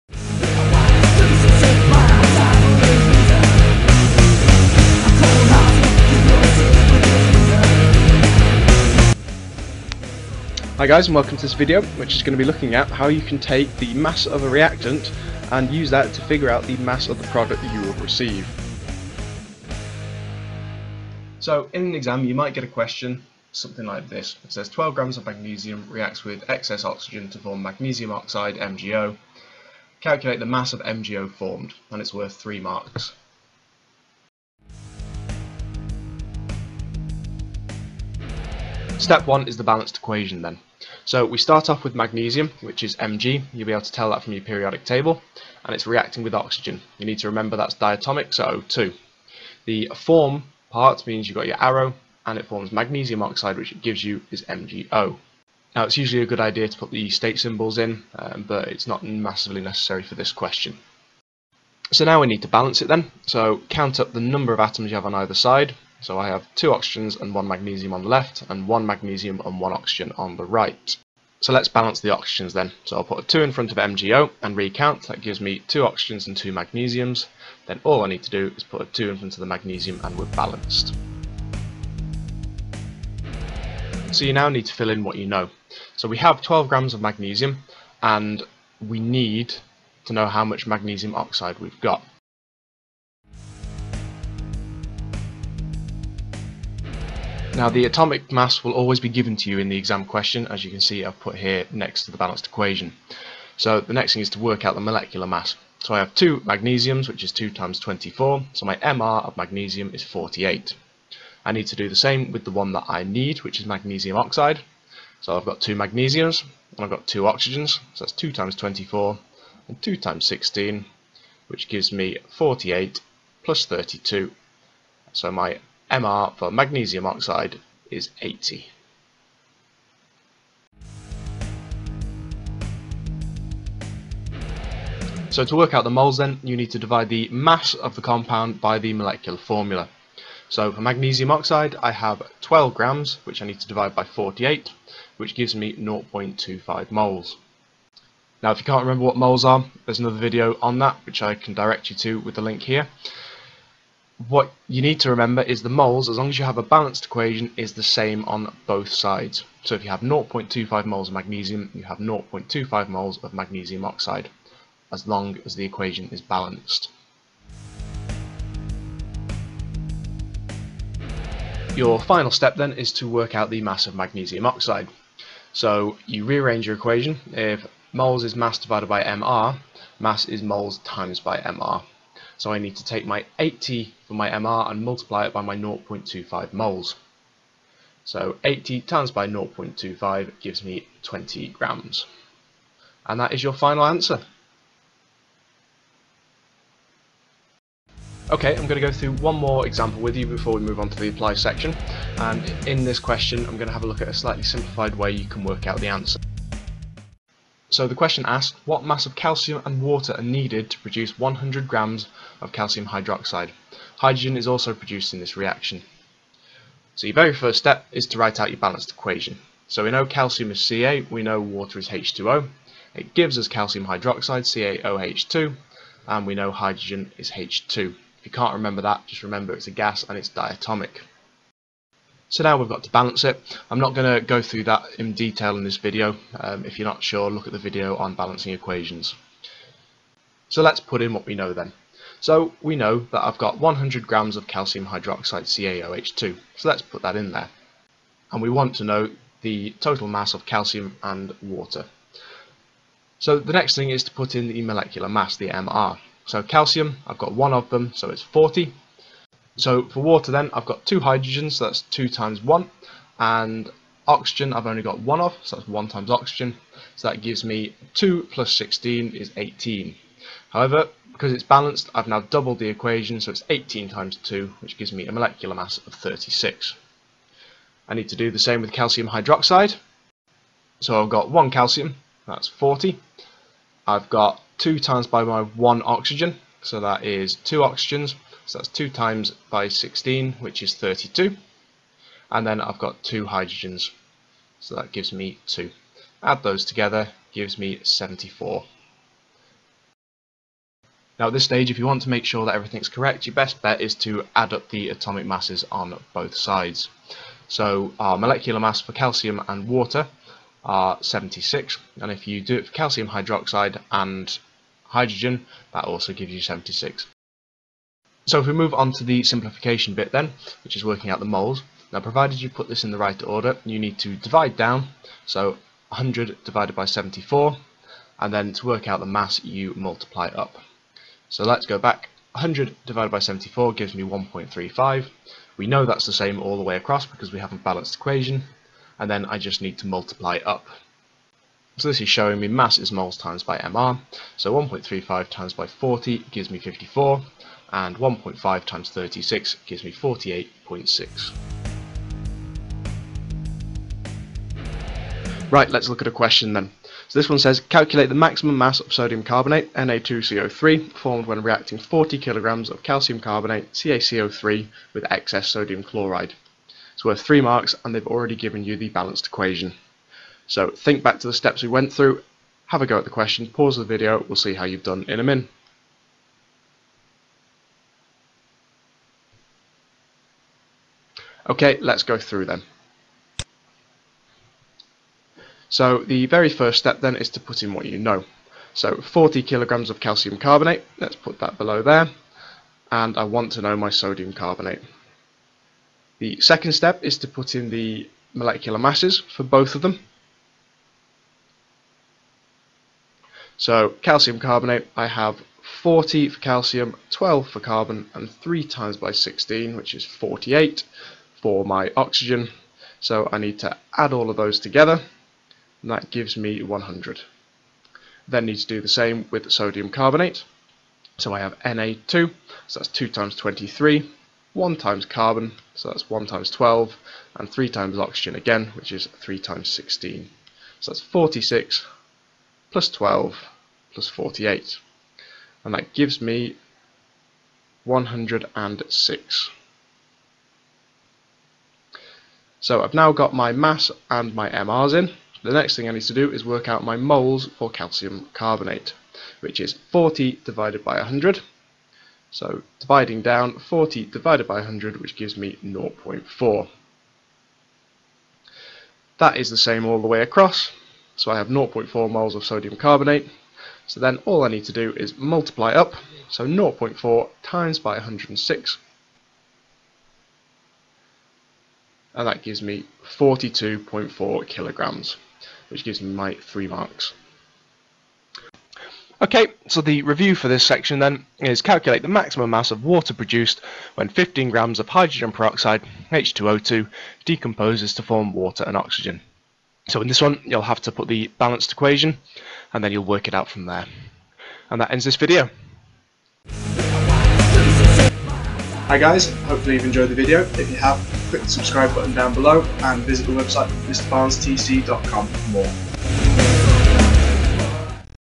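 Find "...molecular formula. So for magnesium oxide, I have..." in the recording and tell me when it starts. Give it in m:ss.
2:18.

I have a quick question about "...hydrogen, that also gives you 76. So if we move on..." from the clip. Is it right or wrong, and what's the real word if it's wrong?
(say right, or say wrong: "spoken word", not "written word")
right.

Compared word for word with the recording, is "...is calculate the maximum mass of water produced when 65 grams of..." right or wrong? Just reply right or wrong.
wrong.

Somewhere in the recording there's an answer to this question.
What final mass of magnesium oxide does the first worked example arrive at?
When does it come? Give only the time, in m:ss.
3:11.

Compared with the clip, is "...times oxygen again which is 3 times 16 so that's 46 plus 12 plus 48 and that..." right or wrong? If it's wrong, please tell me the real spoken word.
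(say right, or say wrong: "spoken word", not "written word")
right.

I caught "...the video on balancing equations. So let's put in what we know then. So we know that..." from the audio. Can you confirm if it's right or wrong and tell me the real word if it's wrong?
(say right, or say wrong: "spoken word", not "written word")
right.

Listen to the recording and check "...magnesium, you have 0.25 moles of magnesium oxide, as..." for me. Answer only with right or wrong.
right.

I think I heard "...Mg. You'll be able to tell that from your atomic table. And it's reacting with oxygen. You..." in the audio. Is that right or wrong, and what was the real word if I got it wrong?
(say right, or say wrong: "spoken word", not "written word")
wrong: "periodic", not "atomic".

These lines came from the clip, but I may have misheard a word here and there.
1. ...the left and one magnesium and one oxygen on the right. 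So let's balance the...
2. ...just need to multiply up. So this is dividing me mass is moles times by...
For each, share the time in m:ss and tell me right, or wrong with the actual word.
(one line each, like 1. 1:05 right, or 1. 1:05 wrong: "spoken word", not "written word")
1. 1:08 right
2. 5:39 wrong: "showing", not "dividing".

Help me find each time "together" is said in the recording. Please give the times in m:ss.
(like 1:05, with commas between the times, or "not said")
4:56, 6:54.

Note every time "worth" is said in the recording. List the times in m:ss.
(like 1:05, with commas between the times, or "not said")
0:32, 6:07.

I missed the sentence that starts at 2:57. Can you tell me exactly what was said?
If moles is mass divided by mR, mass is moles times by mR.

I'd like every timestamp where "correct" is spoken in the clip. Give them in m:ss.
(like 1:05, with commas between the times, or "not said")
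5:02.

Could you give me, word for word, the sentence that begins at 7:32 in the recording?
So dividing down 40 divided by 100, which gives me 0.4.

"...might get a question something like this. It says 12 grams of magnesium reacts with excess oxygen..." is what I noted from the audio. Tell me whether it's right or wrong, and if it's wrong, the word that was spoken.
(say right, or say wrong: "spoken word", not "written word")
right.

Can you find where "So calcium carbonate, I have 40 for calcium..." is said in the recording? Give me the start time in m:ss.
6:43.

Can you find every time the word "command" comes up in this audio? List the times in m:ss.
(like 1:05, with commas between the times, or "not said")
not said.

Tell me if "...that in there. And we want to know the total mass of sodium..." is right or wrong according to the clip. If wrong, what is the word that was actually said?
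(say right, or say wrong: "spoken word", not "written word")
wrong: "calcium", not "sodium".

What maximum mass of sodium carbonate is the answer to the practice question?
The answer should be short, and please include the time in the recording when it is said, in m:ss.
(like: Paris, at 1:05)
42.4 kilograms, at 7:53.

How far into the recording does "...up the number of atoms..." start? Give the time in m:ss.
1:03.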